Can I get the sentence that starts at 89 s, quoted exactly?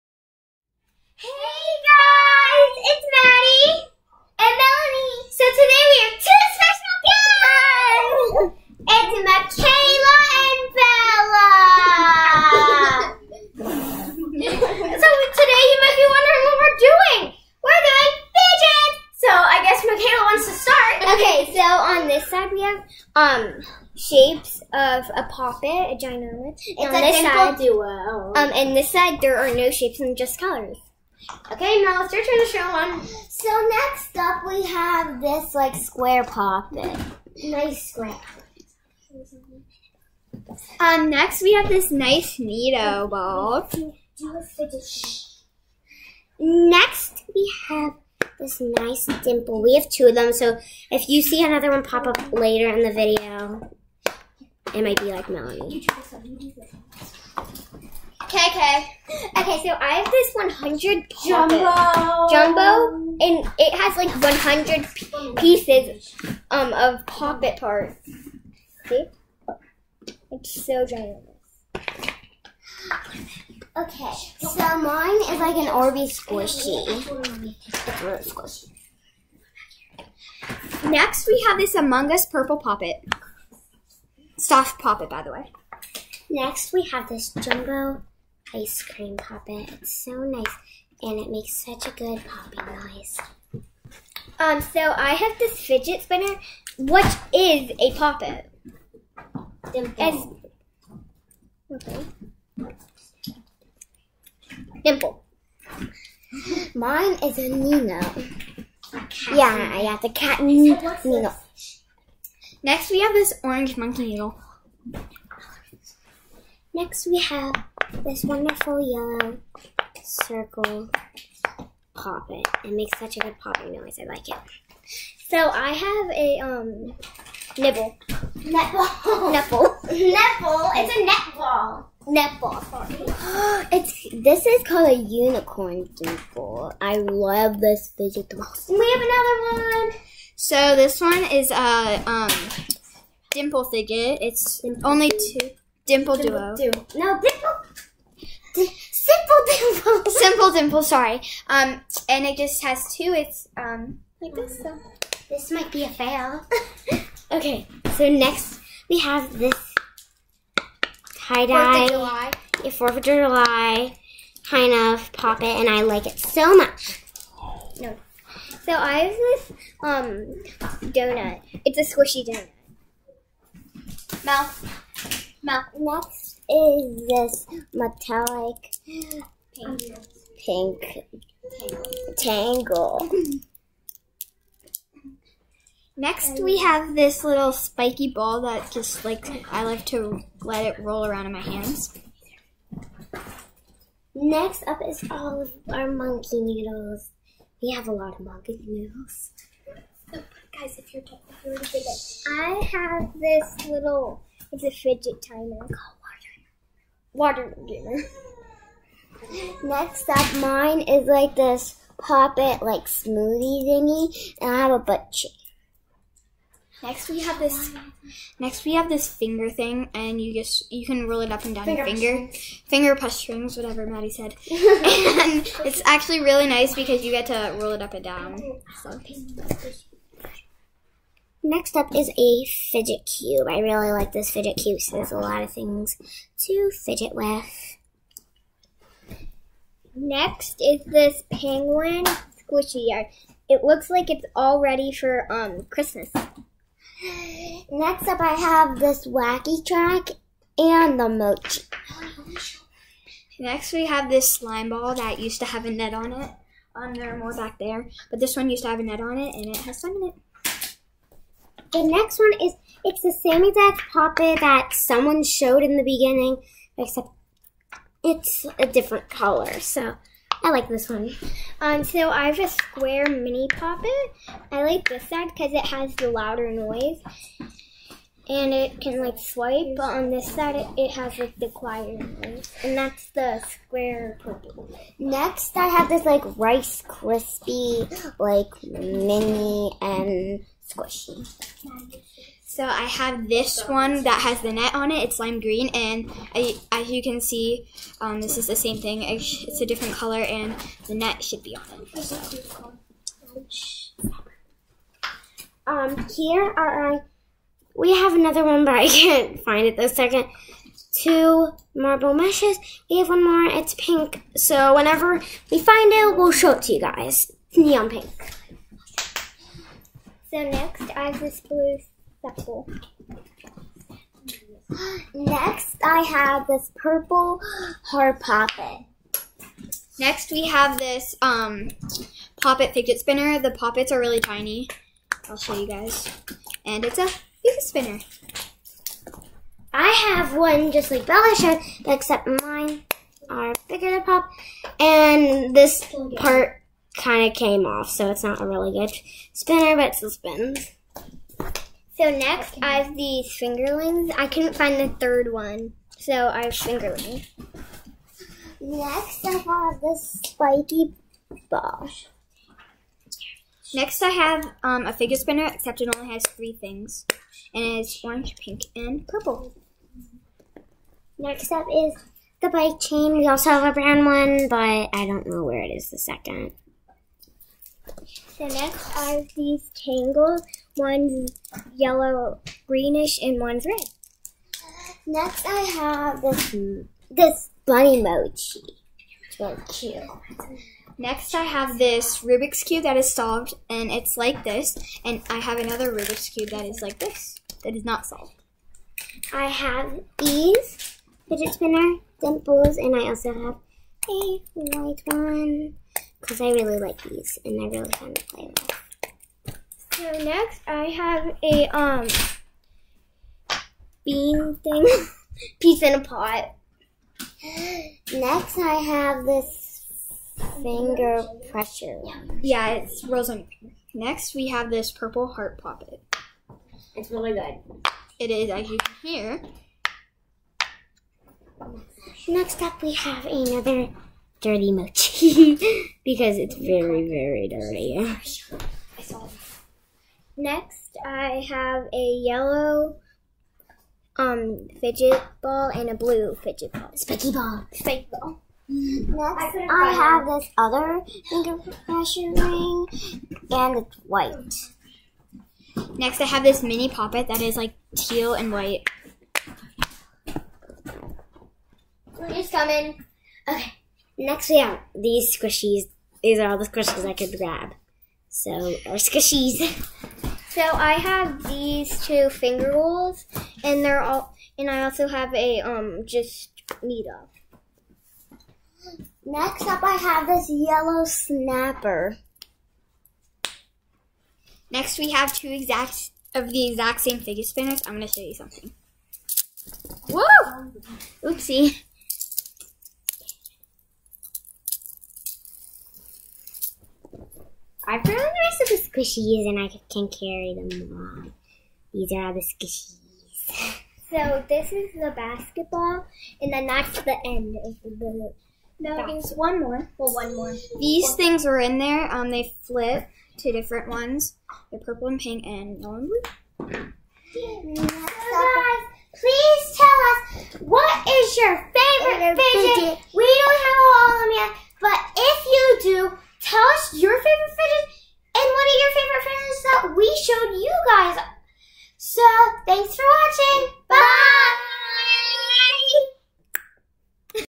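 It's so nice, and it makes such a good popping noise.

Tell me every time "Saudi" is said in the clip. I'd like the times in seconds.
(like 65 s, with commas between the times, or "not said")
not said.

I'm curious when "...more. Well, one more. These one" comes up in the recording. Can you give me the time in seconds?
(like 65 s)
509 s.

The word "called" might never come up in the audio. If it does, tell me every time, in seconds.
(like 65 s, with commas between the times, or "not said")
134 s, 205 s.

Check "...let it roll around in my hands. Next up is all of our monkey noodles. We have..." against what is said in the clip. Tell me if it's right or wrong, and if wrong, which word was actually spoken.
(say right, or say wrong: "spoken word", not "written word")
right.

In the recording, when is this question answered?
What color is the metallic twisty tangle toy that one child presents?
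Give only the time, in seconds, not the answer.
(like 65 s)
177 s.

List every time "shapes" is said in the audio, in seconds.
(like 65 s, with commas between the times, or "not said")
23 s, 29 s.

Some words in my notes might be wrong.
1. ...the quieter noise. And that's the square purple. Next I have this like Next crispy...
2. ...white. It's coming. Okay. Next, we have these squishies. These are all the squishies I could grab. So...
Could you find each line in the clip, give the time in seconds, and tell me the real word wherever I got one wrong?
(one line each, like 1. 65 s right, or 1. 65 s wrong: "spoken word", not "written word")
1. 281 s wrong: "Rice", not "Next"
2. 458 s right.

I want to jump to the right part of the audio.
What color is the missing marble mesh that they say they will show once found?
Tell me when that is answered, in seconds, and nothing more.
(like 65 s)
317 s.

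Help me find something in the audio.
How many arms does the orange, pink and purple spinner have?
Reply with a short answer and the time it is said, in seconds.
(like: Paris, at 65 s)
Three, at 366 s.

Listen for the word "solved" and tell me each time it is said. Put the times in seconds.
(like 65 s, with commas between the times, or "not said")
393 s, 398 s.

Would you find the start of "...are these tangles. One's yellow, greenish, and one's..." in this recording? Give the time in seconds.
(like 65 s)
378 s.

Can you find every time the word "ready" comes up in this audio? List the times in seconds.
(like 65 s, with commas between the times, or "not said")
244 s.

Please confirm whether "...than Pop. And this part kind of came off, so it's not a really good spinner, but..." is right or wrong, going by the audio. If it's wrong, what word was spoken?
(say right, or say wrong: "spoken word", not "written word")
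right.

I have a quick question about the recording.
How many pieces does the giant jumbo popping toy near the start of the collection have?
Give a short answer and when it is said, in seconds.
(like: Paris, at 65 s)
100, at 64 s.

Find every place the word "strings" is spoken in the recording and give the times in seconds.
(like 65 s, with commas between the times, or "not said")
223 s.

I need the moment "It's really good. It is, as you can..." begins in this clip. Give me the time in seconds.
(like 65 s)
426 s.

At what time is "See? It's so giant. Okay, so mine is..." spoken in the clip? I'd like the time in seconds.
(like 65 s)
68 s.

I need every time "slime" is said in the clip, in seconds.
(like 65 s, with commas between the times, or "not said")
254 s, 259 s.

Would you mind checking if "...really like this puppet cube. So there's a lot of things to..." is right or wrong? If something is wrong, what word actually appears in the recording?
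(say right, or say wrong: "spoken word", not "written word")
wrong: "fidget", not "puppet".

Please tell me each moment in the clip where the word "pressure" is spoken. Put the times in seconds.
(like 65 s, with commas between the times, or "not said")
421 s, 451 s.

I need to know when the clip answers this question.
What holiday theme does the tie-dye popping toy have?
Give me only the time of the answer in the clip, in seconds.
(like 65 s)
162 s.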